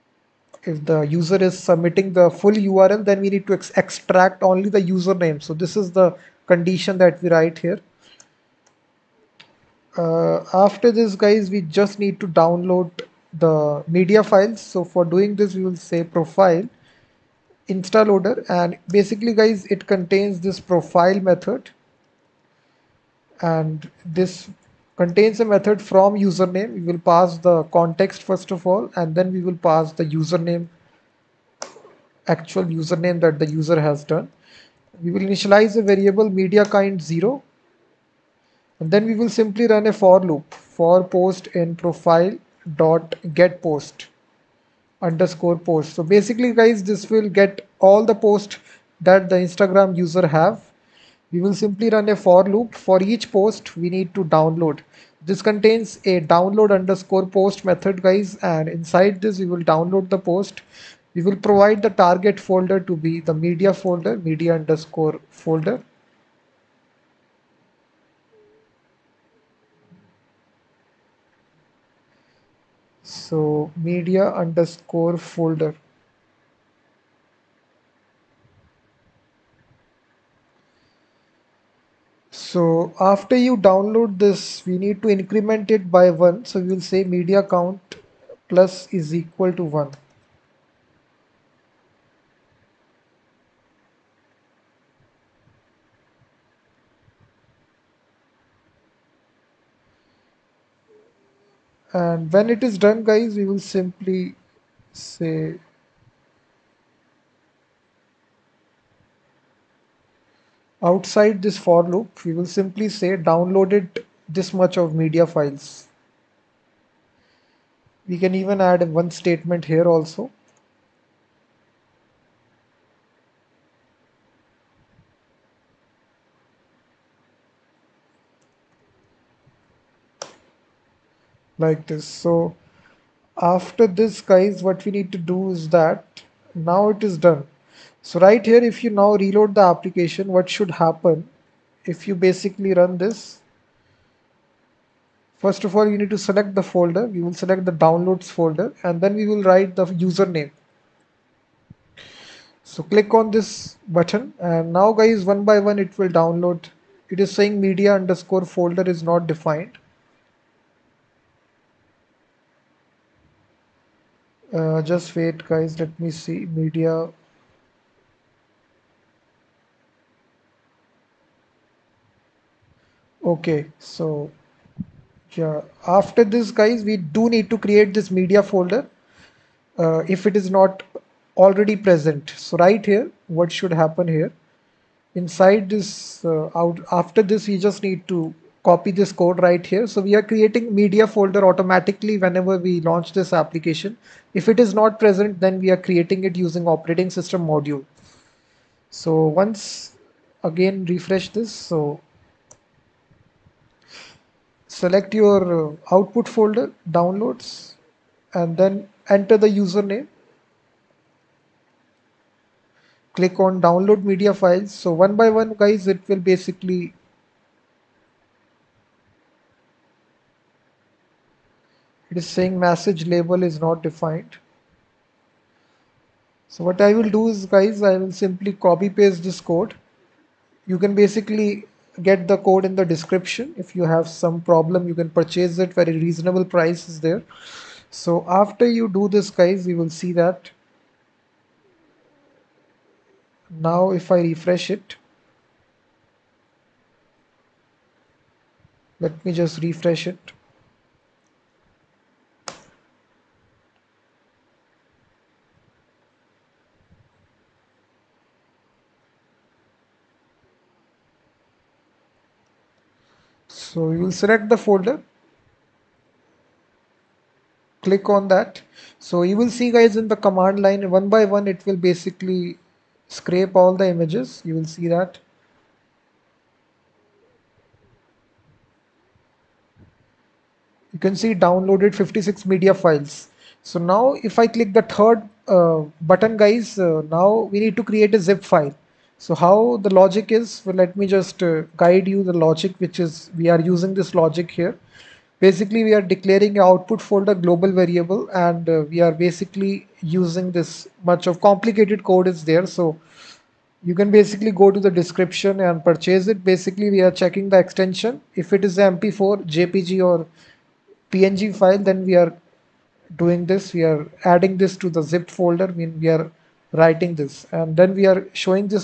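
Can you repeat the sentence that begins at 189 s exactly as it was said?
So we are creating media folder automatically whenever we launch this application.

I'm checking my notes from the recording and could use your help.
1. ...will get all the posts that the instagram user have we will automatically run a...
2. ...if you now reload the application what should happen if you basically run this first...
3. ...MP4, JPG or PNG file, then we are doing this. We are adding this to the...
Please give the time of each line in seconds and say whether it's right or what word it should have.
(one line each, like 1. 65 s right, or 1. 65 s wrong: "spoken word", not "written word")
1. 47 s wrong: "simply", not "automatically"
2. 138 s right
3. 308 s right.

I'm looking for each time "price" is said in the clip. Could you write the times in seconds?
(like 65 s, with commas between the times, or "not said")
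236 s.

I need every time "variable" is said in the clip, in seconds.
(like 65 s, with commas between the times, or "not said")
35 s, 297 s.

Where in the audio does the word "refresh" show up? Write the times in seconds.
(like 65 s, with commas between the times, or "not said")
200 s, 244 s, 249 s.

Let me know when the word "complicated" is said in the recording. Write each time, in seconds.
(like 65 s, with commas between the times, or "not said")
301 s.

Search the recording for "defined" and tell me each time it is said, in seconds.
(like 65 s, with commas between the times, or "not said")
159 s, 223 s.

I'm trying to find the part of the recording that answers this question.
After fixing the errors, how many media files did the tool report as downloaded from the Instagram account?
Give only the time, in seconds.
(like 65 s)
282 s.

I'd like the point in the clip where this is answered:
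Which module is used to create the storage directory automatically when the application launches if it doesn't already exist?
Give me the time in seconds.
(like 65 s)
196 s.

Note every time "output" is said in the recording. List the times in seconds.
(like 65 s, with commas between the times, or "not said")
205 s, 296 s.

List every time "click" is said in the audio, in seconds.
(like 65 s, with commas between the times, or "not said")
152 s, 213 s, 267 s, 284 s.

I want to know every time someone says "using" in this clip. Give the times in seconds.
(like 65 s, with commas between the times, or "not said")
196 s, 293 s, 299 s.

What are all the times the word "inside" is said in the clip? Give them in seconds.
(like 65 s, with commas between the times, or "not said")
58 s, 185 s.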